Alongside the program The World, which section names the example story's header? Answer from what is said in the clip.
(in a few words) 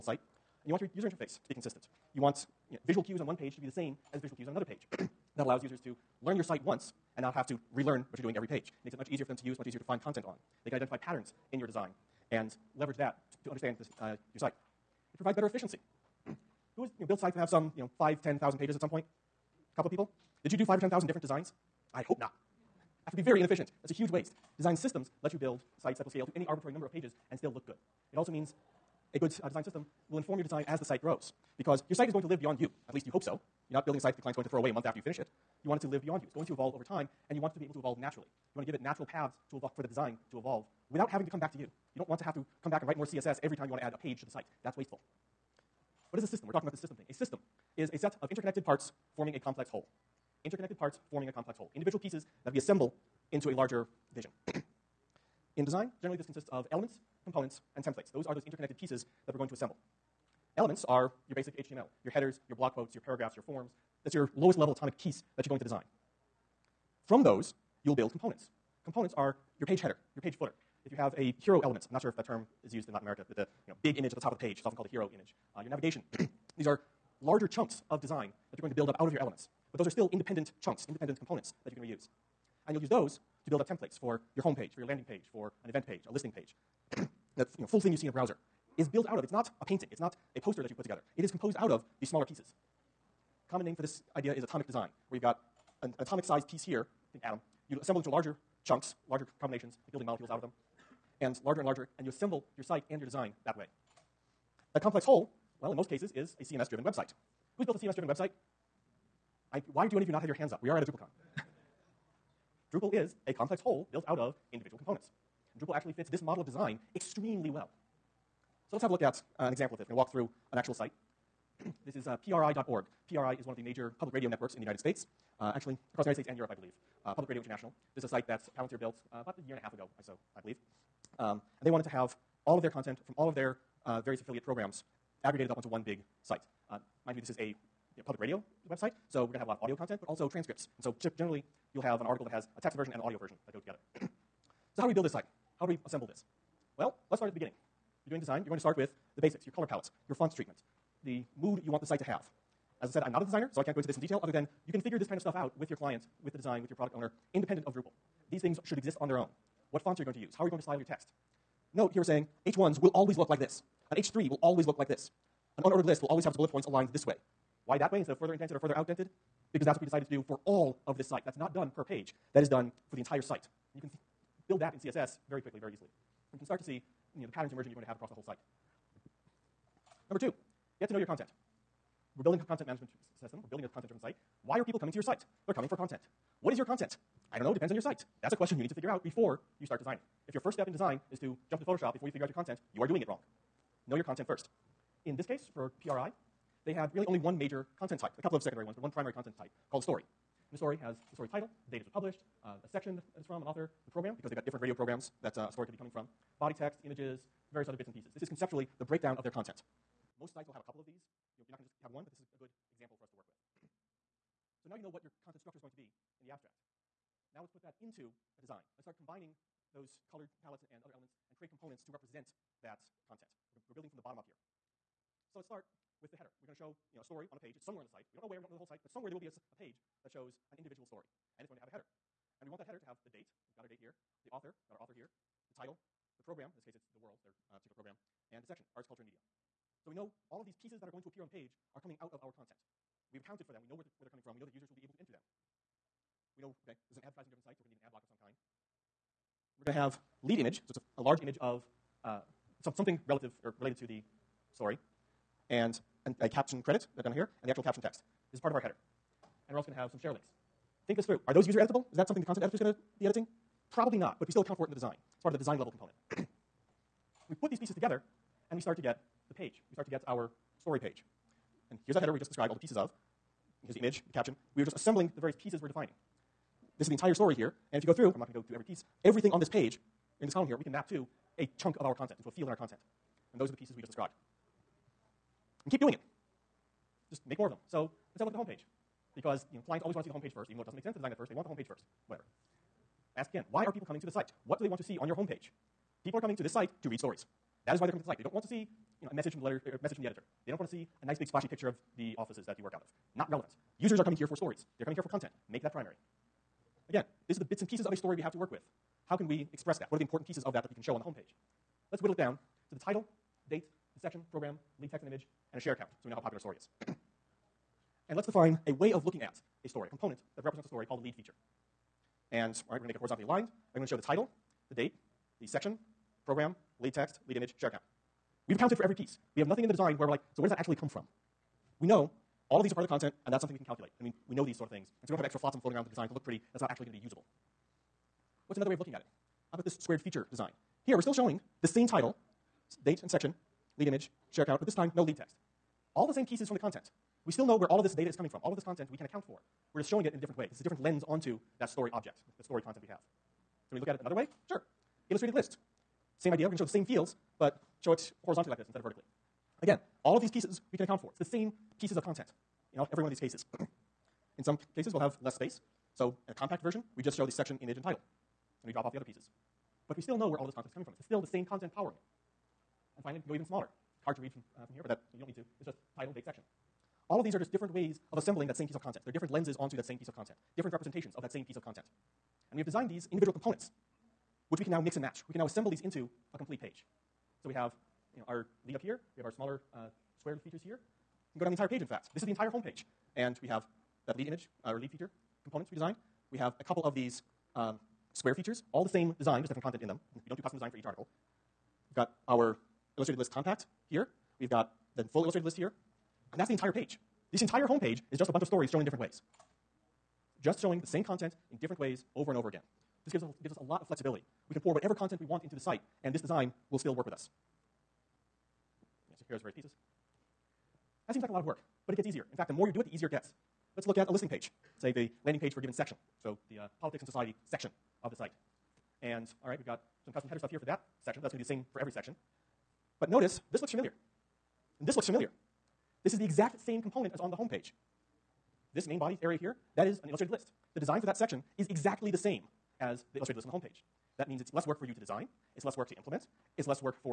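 Arts, culture, and media.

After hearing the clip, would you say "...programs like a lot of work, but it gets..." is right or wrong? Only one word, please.
wrong.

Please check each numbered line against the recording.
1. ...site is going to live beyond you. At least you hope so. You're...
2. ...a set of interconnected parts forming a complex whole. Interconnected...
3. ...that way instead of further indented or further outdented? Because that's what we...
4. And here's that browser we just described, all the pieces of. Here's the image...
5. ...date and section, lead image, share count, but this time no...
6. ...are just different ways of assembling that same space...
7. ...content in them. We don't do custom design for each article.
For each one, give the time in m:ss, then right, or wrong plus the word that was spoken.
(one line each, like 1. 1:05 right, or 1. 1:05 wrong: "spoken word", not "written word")
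1. 0:31 right
2. 0:47 right
3. 2:47 right
4. 4:31 wrong: "header", not "browser"
5. 5:42 right
6. 6:17 wrong: "piece", not "space"
7. 6:39 right.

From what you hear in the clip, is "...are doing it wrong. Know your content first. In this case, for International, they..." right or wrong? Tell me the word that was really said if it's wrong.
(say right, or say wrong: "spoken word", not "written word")
wrong: "PRI", not "International".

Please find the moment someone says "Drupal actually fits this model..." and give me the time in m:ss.
1:55.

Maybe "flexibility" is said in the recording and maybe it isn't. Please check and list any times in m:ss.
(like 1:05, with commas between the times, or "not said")
6:53.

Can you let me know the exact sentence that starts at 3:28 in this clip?
This is conceptually the breakdown of their content.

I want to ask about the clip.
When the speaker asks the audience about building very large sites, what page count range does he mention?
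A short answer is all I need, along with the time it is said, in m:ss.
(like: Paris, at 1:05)
5,000 to 10,000, at 0:17.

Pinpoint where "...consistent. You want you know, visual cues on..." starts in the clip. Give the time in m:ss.
0:01.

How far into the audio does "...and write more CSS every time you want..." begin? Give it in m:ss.
0:42.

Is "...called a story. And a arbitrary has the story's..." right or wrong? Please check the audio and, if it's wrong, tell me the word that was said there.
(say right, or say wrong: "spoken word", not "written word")
wrong: "story", not "arbitrary".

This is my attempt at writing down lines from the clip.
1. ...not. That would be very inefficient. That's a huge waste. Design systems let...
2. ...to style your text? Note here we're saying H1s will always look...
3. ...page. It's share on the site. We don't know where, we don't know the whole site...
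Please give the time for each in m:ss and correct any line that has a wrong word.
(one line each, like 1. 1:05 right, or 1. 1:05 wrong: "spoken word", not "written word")
1. 0:22 right
2. 2:40 right
3. 3:47 wrong: "somewhere", not "share".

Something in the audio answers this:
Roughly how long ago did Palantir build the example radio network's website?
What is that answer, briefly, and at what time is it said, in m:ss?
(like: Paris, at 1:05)
About a year and a half, at 2:09.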